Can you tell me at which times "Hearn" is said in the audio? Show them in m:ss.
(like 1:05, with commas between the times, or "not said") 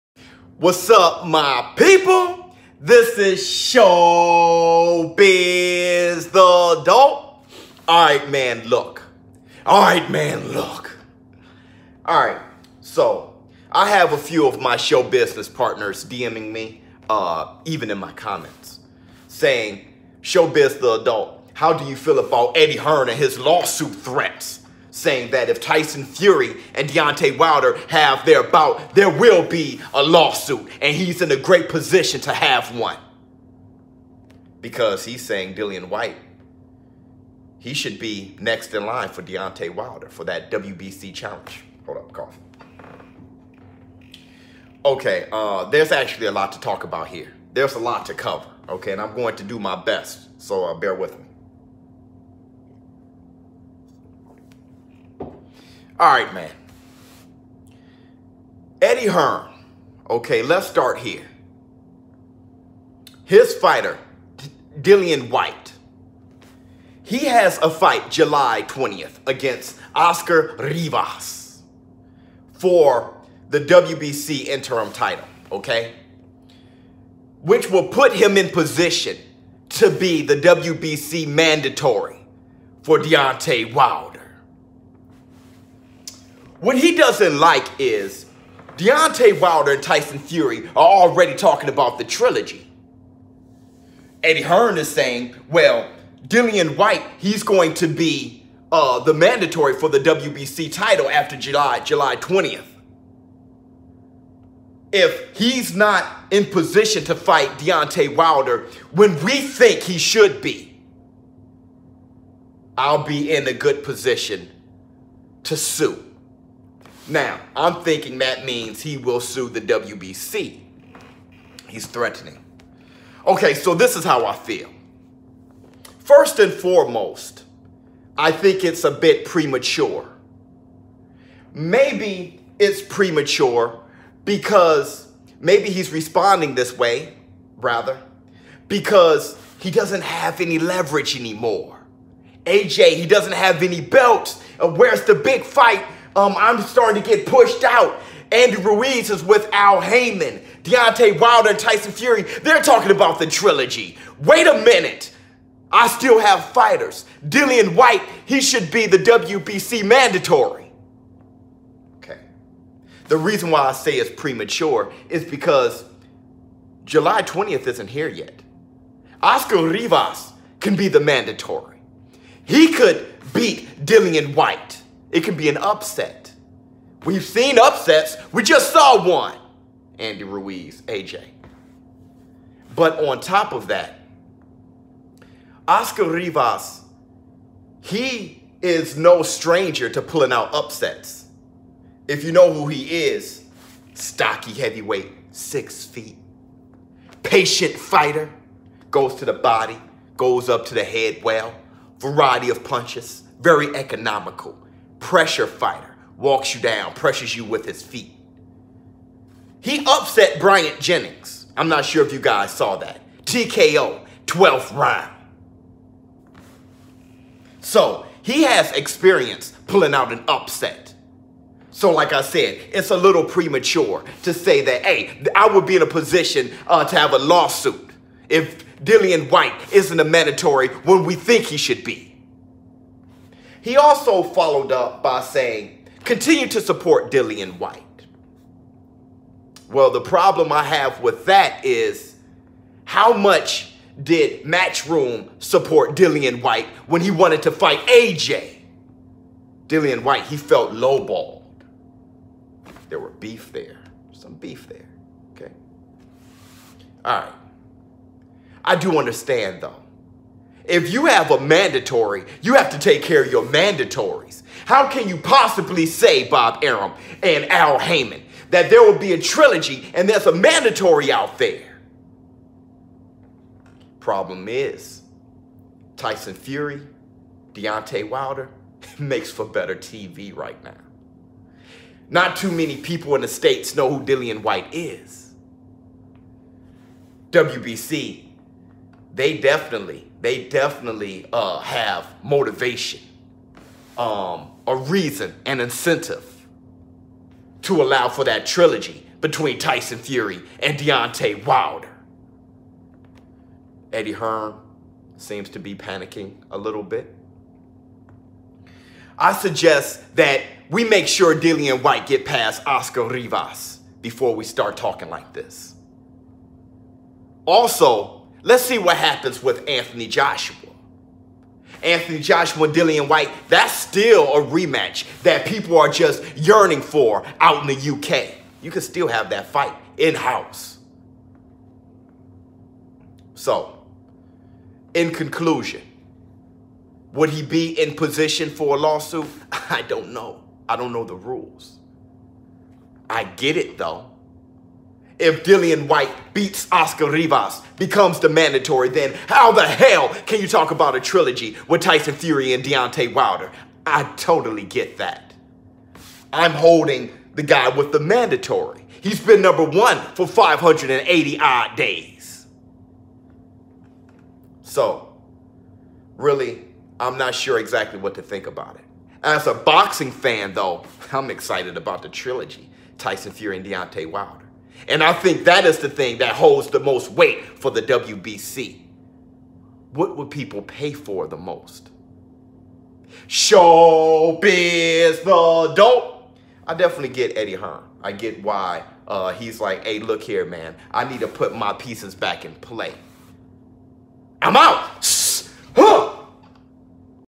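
0:22, 0:59, 1:34, 5:04, 6:27.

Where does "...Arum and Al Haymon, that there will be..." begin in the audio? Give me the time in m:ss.
4:26.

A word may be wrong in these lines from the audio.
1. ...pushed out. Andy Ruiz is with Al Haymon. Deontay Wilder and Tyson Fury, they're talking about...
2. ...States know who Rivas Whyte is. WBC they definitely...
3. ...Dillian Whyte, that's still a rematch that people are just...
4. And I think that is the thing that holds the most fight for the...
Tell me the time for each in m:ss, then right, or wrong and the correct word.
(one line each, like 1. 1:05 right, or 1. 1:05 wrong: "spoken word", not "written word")
1. 2:27 right
2. 4:43 wrong: "Dillian", not "Rivas"
3. 5:22 right
4. 6:14 wrong: "weight", not "fight".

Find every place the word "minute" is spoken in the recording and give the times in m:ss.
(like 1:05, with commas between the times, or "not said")
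2:34.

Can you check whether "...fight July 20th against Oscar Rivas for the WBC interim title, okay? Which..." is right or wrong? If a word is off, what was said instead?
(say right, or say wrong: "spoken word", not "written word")
right.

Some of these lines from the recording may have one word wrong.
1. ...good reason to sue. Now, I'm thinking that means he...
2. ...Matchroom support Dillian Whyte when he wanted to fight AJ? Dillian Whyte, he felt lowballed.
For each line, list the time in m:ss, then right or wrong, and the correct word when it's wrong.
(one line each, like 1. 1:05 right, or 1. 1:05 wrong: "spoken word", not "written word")
1. 1:53 wrong: "position", not "reason"
2. 4:04 right.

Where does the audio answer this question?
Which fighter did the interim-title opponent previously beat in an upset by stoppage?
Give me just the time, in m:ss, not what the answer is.
3:30.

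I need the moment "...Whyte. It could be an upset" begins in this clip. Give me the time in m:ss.
2:54.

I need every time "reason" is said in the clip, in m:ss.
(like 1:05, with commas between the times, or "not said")
2:43, 4:54.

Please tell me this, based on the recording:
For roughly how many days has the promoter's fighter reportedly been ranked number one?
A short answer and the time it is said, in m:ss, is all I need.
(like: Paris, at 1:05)
580, at 6:00.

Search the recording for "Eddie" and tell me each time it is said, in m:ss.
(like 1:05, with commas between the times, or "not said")
0:22, 0:58, 1:34, 5:03, 6:27.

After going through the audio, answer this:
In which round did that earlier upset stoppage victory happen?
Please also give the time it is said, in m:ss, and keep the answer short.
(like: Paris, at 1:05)
12th round, at 3:34.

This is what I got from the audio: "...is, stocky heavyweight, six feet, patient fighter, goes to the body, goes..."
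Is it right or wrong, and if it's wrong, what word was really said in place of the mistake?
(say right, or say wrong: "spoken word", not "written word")
right.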